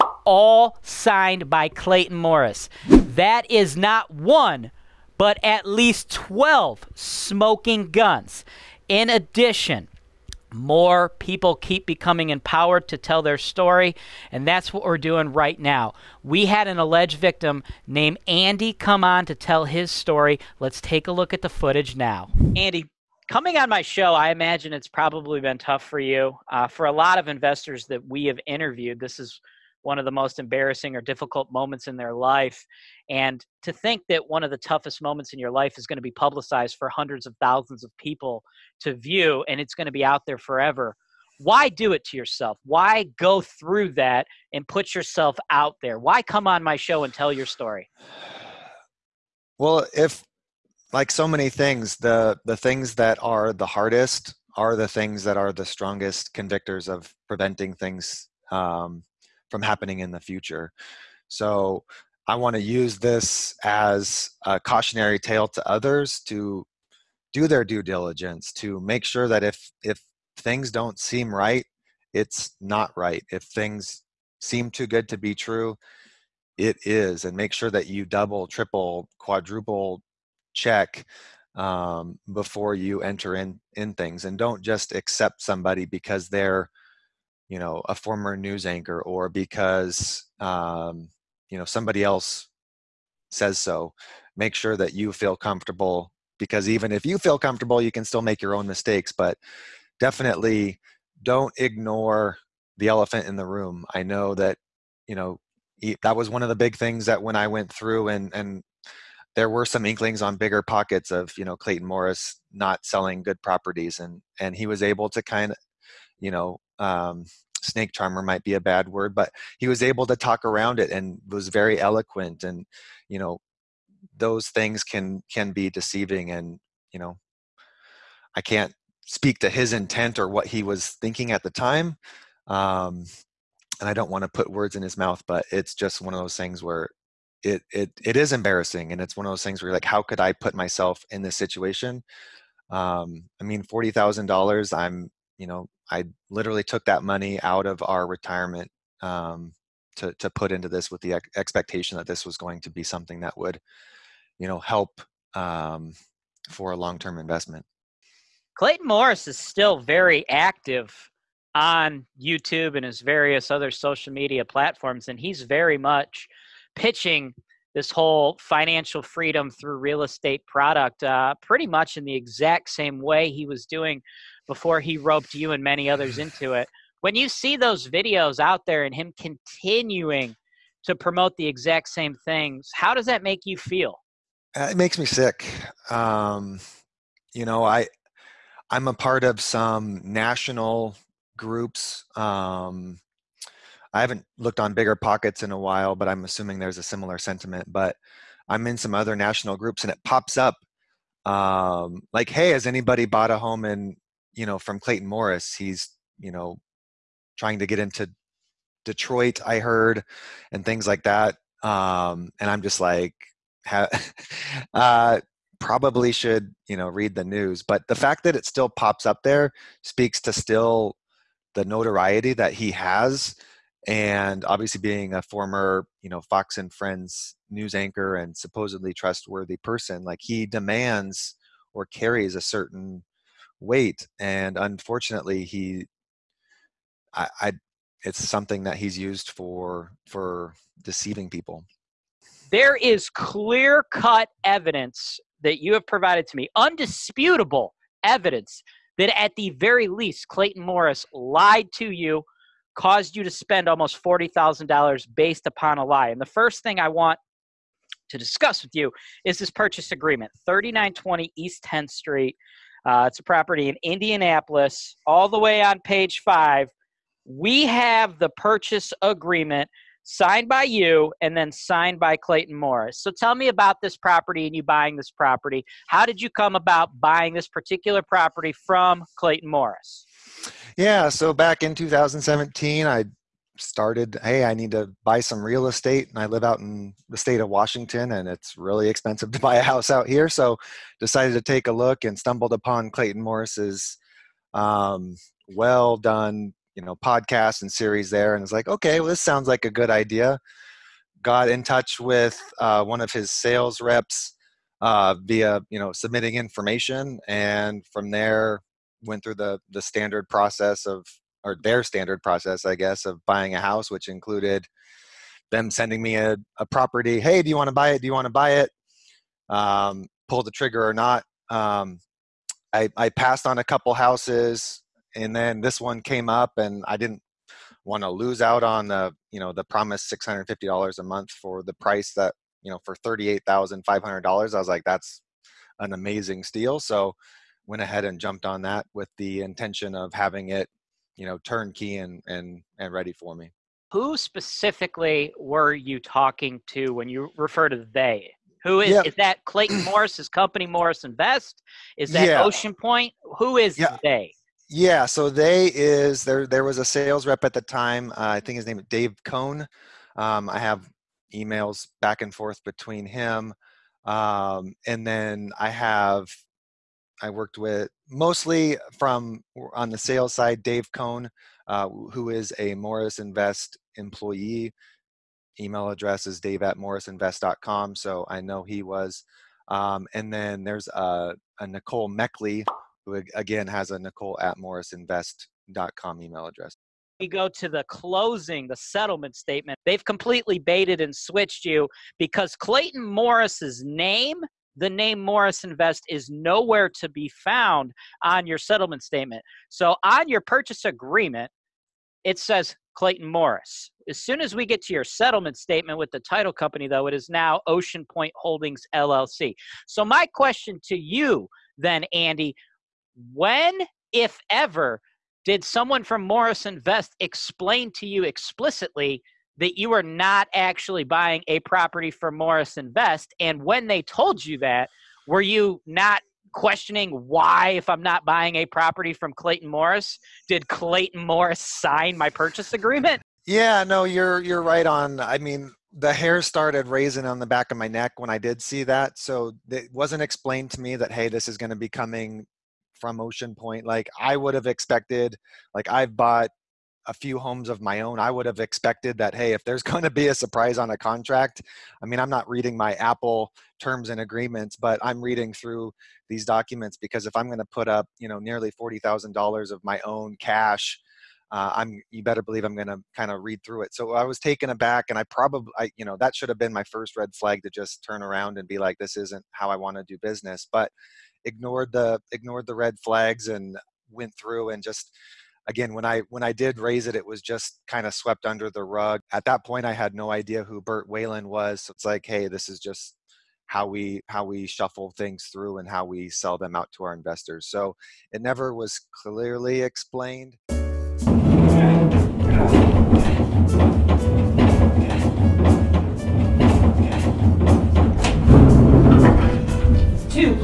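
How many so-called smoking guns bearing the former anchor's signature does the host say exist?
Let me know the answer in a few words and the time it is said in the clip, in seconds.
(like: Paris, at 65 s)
12, at 6 s.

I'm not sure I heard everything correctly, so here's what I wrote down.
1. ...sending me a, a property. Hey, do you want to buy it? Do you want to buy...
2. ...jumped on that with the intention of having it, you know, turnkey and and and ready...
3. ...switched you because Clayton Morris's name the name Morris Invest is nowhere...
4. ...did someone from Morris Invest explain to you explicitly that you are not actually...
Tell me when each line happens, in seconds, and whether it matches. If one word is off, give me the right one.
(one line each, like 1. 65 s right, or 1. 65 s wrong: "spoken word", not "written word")
1. 315 s right
2. 338 s right
3. 391 s right
4. 415 s right.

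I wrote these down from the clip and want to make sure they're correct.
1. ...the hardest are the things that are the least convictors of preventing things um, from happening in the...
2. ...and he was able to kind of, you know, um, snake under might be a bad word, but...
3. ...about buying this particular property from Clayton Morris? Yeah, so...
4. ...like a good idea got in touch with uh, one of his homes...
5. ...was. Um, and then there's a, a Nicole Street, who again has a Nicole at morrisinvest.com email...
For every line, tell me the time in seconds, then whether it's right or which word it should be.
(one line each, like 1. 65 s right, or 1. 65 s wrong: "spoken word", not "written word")
1. 53 s wrong: "strongest", not "least"
2. 114 s wrong: "charmer", not "under"
3. 276 s right
4. 299 s wrong: "sales", not "homes"
5. 378 s wrong: "Meckley", not "Street".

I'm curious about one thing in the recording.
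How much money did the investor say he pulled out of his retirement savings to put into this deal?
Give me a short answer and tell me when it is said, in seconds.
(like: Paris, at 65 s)
$40,000, at 143 s.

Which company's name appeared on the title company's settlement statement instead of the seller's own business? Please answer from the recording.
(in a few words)
Ocean Point Holdings LLC.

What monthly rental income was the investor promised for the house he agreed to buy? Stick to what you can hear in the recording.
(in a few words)
$650.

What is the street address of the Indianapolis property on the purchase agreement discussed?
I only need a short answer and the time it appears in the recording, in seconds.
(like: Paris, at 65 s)
3920 East 10th Street, at 260 s.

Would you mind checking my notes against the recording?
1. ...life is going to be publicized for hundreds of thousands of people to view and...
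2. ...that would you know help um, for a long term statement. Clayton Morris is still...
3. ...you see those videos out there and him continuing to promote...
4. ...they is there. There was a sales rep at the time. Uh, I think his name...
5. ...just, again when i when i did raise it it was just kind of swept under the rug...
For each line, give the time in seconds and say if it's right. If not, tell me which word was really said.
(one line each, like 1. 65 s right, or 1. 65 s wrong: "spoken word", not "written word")
1. 35 s right
2. 153 s wrong: "investment", not "statement"
3. 177 s right
4. 355 s right
5. 474 s right.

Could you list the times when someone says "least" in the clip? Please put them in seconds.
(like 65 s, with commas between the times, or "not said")
5 s, 249 s.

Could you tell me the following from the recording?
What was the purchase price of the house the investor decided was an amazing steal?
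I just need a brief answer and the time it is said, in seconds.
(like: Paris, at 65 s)
$38,500, at 333 s.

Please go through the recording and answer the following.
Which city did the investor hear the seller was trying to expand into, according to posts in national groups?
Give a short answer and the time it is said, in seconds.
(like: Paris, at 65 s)
Detroit, at 208 s.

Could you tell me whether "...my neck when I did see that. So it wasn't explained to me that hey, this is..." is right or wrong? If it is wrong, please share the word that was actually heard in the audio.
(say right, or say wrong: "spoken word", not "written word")
right.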